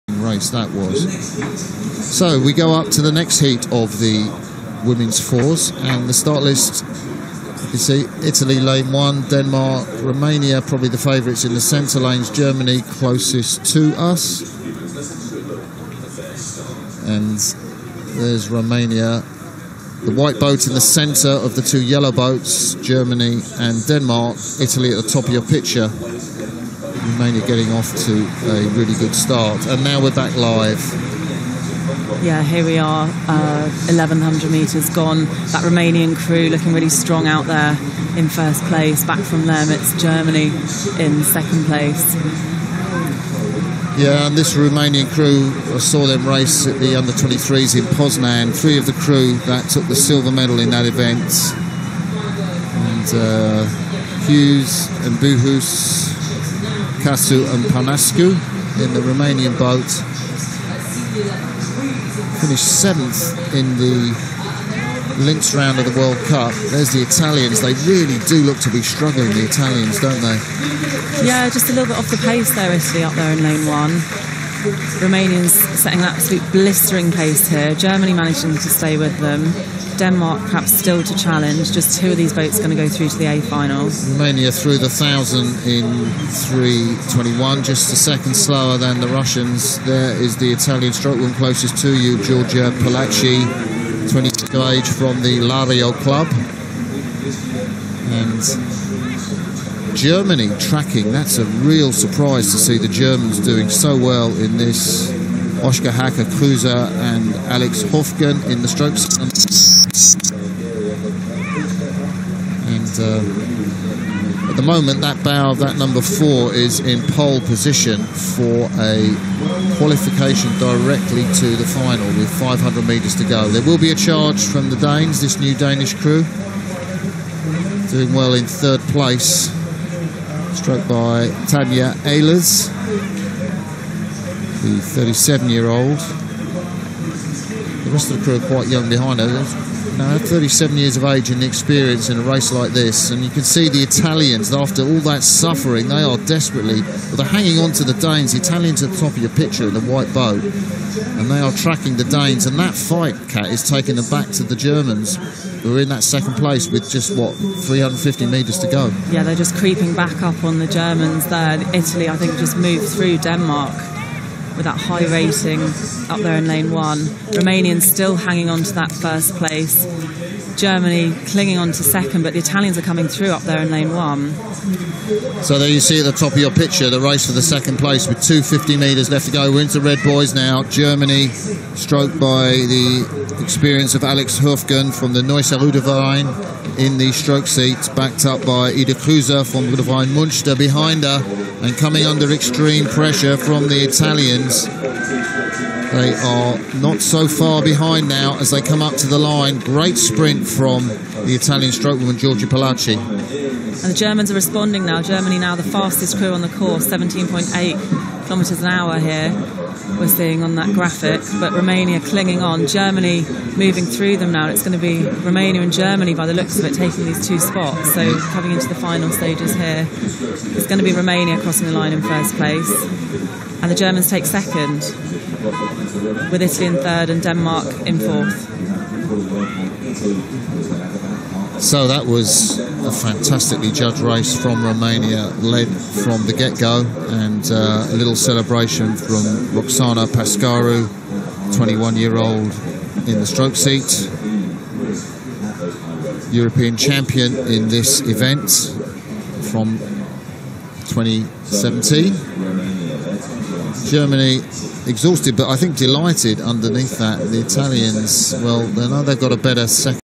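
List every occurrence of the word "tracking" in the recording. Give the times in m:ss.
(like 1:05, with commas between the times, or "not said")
1:40, 2:31.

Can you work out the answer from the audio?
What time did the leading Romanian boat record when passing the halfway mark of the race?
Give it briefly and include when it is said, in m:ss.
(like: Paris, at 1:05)
3.21, at 1:26.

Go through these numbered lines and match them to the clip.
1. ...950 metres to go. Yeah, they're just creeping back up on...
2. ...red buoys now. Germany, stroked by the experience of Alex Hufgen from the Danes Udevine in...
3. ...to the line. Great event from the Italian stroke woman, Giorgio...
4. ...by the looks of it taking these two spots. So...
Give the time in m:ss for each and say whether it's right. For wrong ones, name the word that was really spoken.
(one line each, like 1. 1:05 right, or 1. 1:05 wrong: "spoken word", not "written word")
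1. 2:37 wrong: "350", not "950"
2. 2:59 wrong: "Neusel", not "Danes"
3. 3:18 wrong: "sprint", not "event"
4. 3:36 right.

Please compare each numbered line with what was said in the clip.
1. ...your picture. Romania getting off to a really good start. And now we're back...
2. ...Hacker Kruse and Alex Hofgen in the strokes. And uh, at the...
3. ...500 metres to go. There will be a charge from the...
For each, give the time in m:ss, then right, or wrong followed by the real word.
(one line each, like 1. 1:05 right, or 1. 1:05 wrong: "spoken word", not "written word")
1. 0:25 right
2. 1:45 right
3. 2:02 right.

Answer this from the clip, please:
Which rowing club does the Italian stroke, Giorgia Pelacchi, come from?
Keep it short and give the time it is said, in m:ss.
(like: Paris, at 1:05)
Lario Club, at 1:35.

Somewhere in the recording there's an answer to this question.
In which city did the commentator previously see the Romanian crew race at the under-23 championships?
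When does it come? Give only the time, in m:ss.
0:47.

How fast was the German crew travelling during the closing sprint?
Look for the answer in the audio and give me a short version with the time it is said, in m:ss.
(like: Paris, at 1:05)
17.8 kilometres an hour, at 3:26.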